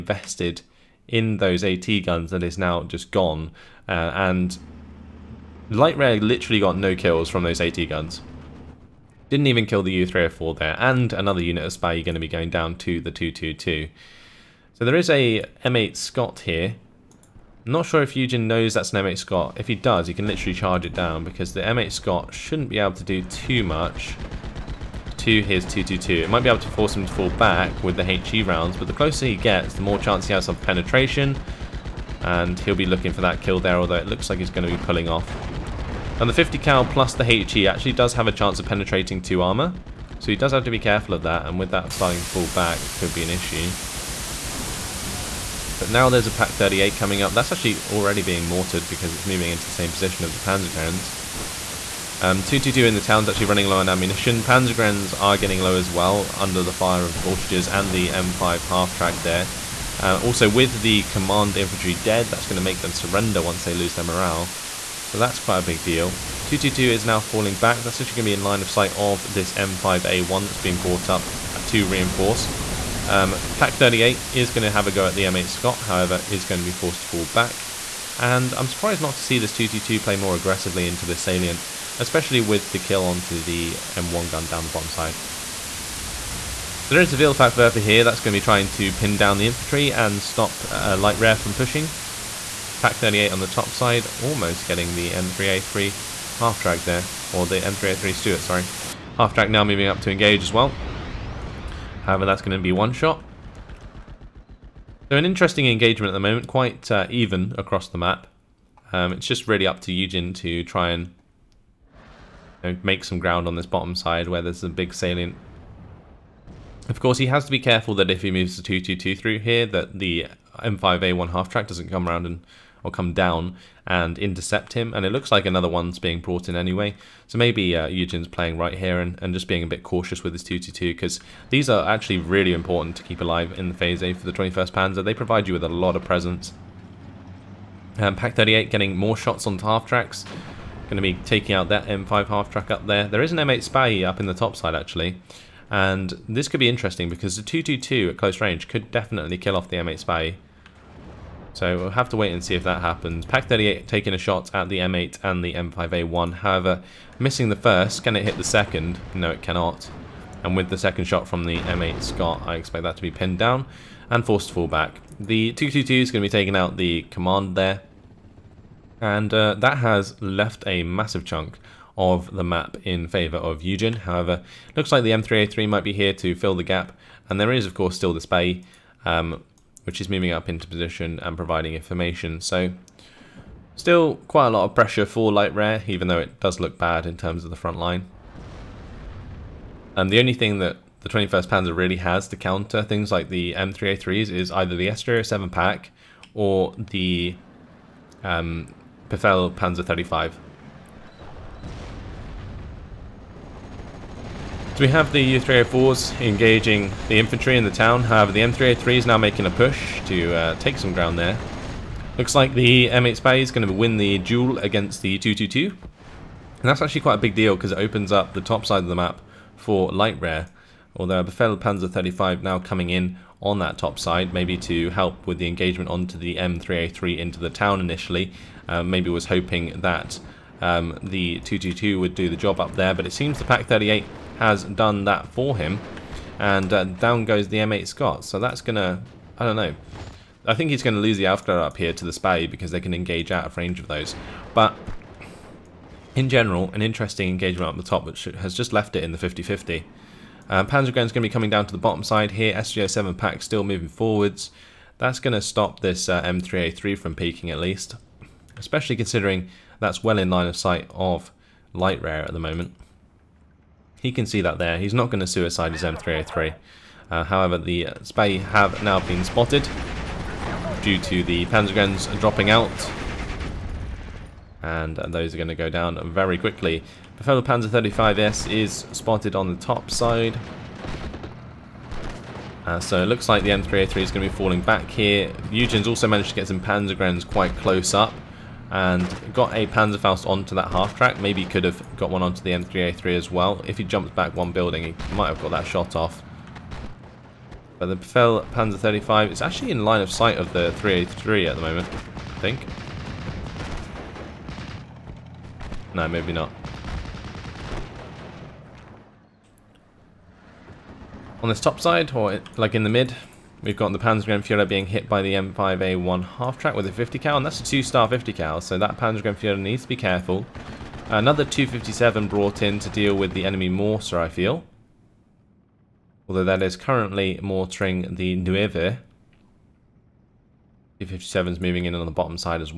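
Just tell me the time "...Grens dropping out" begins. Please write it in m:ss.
4:31.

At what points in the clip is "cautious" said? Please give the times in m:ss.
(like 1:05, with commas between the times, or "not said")
2:09.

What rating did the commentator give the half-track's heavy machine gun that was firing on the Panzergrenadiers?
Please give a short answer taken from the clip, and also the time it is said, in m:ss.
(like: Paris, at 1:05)
2 star, at 5:17.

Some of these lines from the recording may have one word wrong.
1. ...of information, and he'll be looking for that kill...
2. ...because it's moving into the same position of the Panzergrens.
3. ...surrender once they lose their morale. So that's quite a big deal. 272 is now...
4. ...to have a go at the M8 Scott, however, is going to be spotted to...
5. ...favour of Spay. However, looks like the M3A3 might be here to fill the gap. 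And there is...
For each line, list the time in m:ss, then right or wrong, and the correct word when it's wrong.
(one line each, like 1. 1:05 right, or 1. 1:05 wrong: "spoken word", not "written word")
1. 0:30 wrong: "penetration", not "information"
2. 0:48 right
3. 1:02 wrong: "222", not "272"
4. 1:14 wrong: "forced", not "spotted"
5. 2:53 wrong: "YueJin", not "Spay".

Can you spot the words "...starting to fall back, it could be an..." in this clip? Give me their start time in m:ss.
0:41.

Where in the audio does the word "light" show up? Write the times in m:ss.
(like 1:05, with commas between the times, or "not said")
0:05, 1:30, 3:05, 3:39, 4:21.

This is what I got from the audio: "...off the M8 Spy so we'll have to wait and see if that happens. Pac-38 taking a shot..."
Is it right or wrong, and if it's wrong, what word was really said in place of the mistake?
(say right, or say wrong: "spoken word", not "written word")
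right.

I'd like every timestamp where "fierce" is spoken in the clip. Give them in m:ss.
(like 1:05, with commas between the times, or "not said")
not said.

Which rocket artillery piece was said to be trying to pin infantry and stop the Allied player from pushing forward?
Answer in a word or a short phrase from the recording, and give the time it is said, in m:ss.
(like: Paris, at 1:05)
Vielfachwerfer, at 1:27.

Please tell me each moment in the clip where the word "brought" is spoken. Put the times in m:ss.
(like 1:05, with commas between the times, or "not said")
1:10, 2:06, 5:22.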